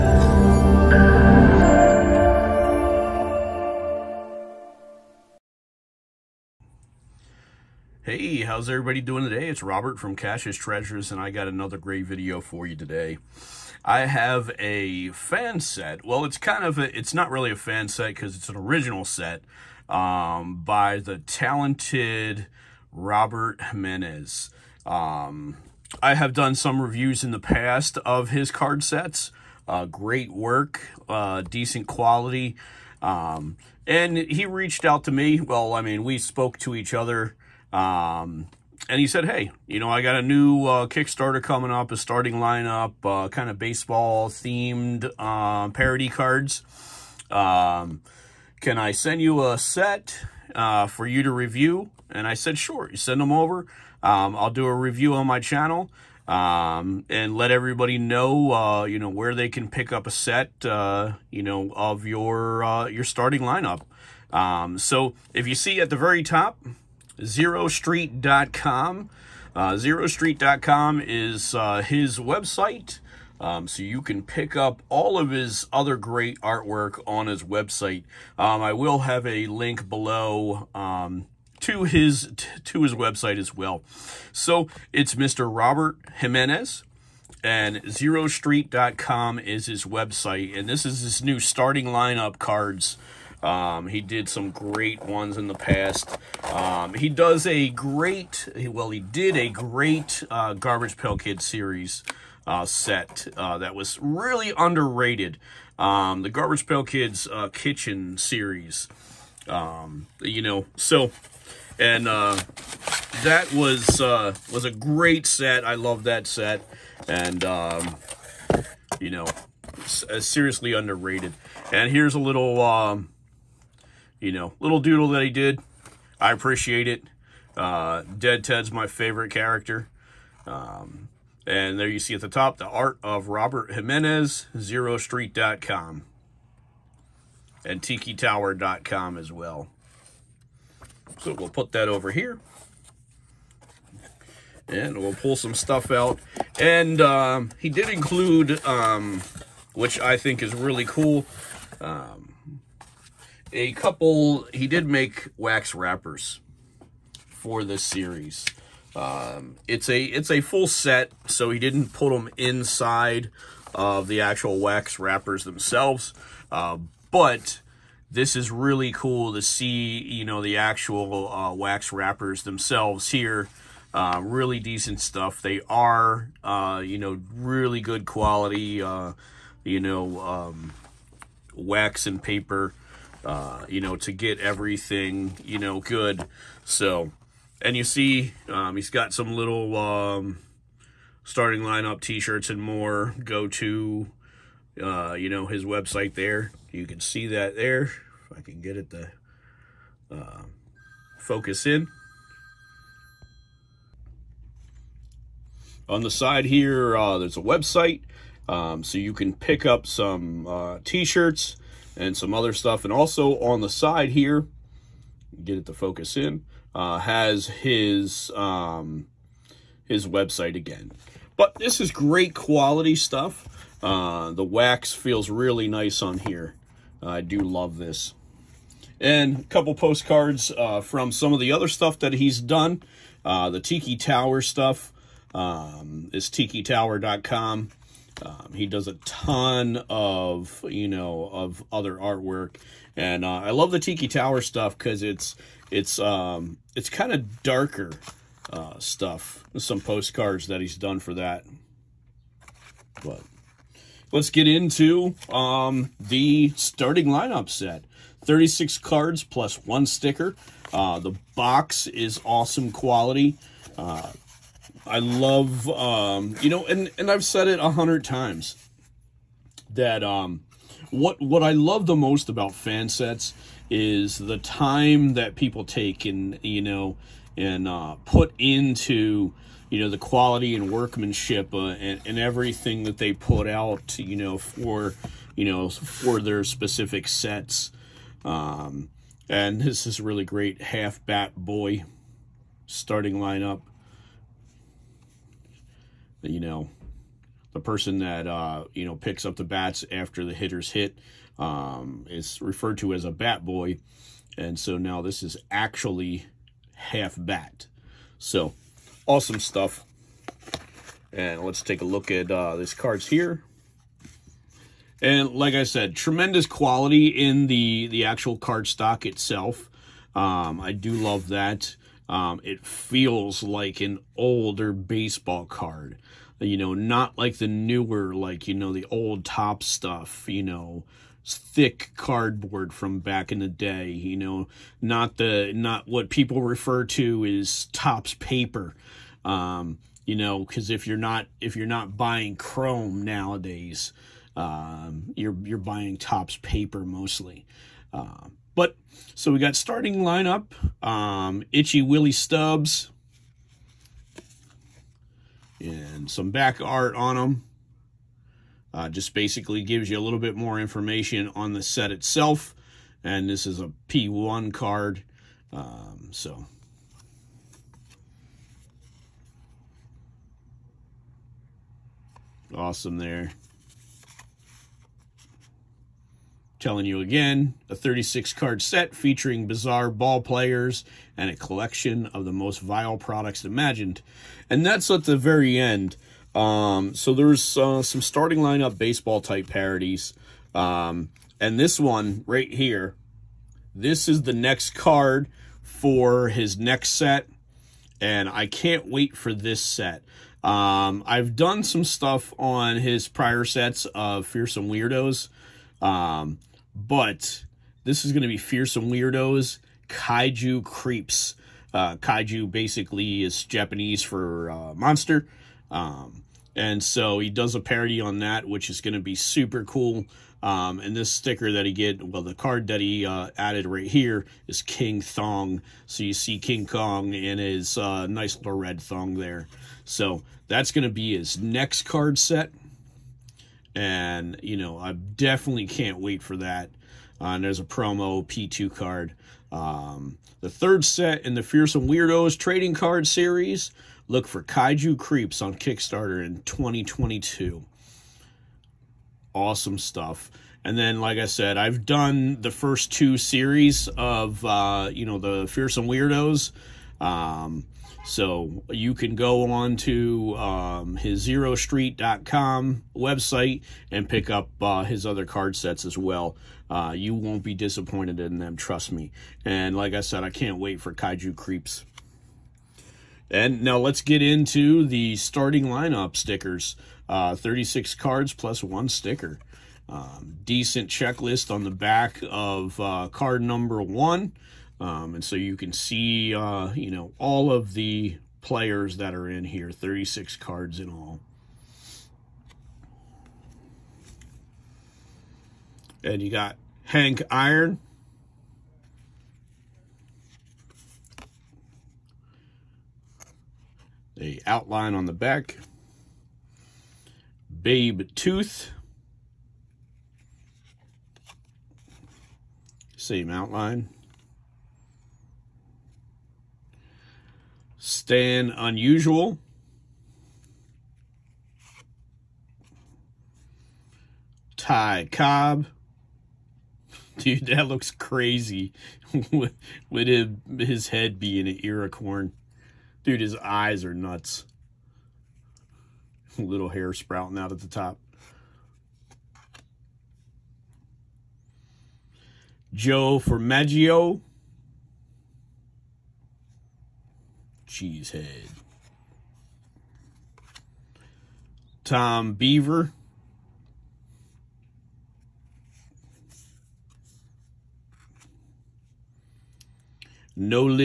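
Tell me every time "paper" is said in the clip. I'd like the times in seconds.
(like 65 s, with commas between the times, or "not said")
182 s, 338 s, 346 s.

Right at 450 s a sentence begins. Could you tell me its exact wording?
And then, like I said, I've done the first two series of, uh, you know, the Fearsome Weirdos.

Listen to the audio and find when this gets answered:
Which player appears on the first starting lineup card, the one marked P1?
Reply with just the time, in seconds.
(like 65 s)
351 s.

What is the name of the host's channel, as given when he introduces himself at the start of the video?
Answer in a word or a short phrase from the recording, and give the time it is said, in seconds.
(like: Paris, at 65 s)
Cash's Treasures, at 10 s.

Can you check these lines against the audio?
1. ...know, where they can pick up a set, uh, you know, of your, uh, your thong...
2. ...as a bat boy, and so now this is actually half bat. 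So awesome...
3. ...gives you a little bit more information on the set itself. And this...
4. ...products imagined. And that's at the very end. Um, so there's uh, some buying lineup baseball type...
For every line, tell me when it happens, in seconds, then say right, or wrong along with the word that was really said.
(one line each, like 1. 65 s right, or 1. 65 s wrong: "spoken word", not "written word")
1. 58 s wrong: "starting", not "thong"
2. 302 s right
3. 359 s right
4. 382 s wrong: "starting", not "buying".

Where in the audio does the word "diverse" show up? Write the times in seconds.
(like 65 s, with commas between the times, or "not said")
not said.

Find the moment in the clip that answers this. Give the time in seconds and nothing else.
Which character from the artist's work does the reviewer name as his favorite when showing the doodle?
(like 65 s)
128 s.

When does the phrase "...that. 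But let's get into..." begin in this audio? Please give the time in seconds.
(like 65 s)
251 s.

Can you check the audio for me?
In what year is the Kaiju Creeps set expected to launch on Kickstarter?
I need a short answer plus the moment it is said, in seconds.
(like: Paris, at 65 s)
2022, at 446 s.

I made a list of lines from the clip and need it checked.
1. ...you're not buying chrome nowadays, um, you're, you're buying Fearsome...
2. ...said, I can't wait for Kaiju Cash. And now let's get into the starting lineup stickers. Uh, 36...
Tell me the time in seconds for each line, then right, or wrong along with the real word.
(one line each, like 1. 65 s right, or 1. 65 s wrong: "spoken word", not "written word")
1. 341 s wrong: "Topps", not "Fearsome"
2. 470 s wrong: "Creeps", not "Cash".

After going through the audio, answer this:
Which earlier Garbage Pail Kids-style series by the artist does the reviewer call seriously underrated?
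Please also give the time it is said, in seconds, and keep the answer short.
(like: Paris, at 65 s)
Kitchen series, at 107 s.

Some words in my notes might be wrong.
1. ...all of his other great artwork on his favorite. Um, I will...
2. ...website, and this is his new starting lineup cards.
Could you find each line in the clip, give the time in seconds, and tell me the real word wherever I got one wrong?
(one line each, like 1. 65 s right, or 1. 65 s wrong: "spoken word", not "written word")
1. 74 s wrong: "website", not "favorite"
2. 89 s right.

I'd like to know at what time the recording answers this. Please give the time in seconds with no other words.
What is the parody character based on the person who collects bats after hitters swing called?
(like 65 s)
290 s.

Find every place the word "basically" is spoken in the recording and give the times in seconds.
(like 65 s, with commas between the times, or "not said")
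359 s, 412 s.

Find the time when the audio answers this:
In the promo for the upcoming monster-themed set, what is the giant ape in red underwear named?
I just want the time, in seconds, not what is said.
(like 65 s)
424 s.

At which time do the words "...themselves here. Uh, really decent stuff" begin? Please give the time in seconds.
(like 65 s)
172 s.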